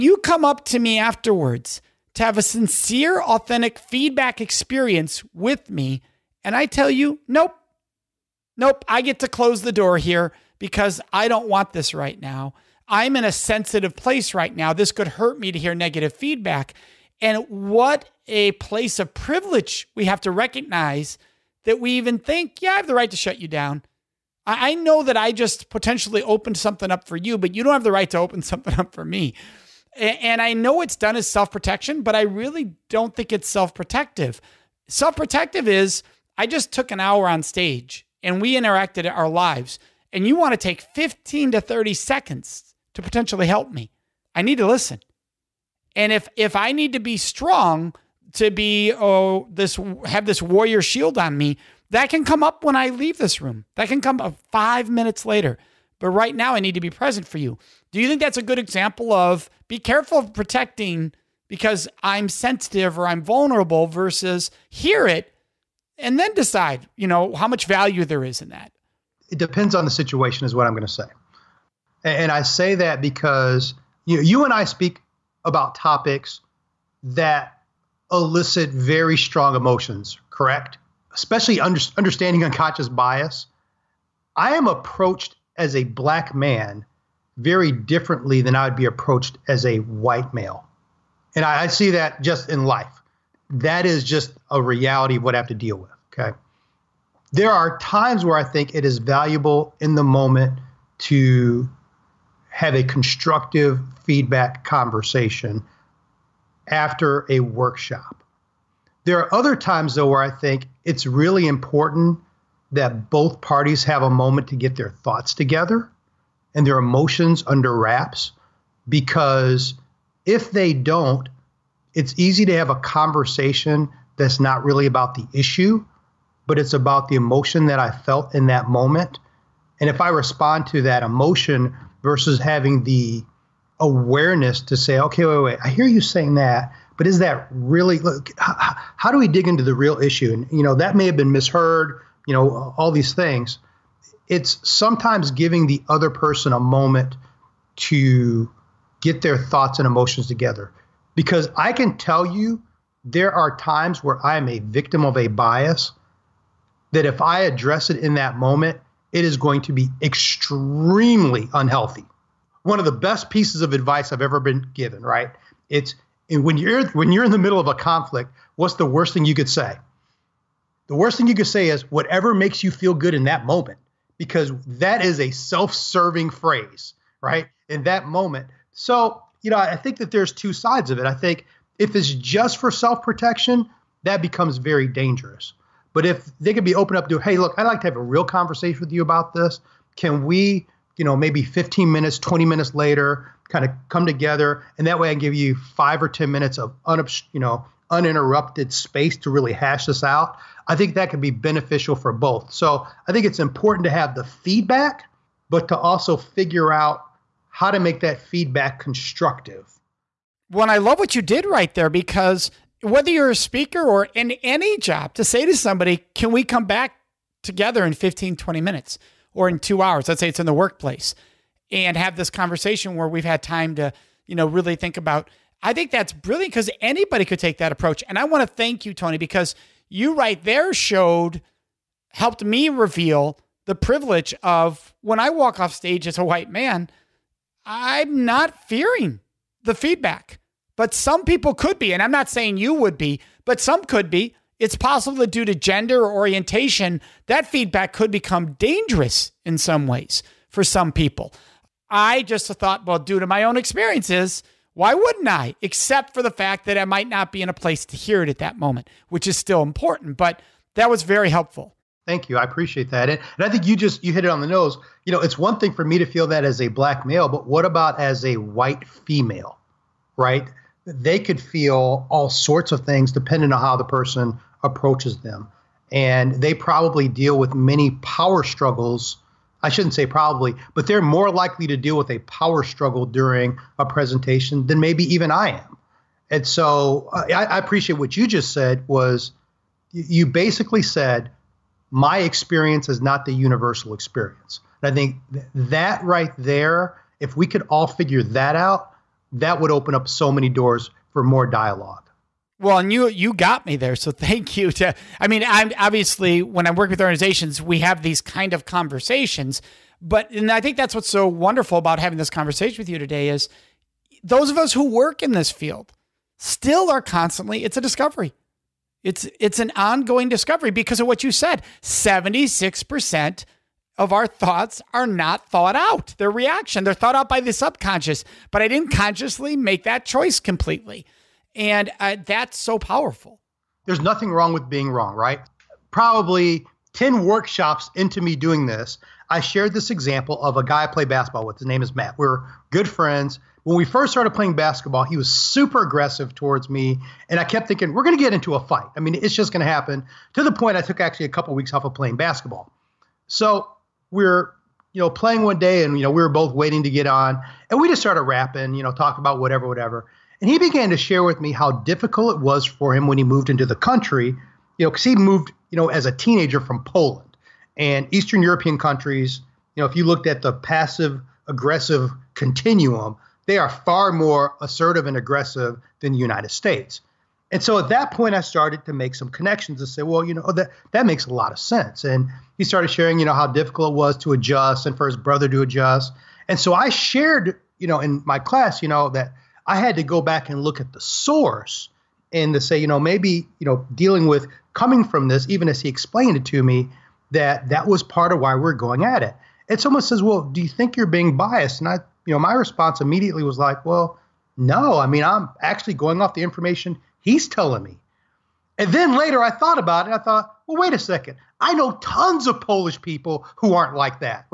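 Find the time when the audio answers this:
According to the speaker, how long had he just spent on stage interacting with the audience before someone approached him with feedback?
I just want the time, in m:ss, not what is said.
0:36.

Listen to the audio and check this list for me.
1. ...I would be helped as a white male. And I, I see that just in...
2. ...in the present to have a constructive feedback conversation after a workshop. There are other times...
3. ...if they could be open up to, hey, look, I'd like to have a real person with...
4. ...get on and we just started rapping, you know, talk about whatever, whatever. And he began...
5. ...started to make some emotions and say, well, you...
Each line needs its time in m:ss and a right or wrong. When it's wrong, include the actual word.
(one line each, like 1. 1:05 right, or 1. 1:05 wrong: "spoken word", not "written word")
1. 1:28 wrong: "approached", not "helped"
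2. 1:39 wrong: "moment", not "present"
3. 3:06 wrong: "conversation", not "person"
4. 5:56 right
5. 6:18 wrong: "connections", not "emotions".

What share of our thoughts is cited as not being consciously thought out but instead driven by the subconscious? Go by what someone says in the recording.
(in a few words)
76 percent.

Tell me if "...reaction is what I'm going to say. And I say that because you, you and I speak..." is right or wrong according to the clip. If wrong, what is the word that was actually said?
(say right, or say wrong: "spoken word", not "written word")
wrong: "situation", not "reaction".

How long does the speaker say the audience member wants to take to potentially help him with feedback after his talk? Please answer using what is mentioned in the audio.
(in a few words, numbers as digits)
15 to 30 seconds.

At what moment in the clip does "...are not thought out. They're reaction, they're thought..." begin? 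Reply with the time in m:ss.
5:24.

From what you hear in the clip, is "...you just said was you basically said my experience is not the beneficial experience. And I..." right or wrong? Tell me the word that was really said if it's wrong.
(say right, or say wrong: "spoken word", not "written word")
wrong: "universal", not "beneficial".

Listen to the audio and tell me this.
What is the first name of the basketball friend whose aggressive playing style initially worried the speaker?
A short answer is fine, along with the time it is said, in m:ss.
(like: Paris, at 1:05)
Matt, at 5:41.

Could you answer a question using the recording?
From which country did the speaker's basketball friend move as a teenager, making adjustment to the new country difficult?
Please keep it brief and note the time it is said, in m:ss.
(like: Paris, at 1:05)
Poland, at 6:06.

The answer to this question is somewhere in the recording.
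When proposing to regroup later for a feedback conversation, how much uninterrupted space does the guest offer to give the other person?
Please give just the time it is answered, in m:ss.
3:15.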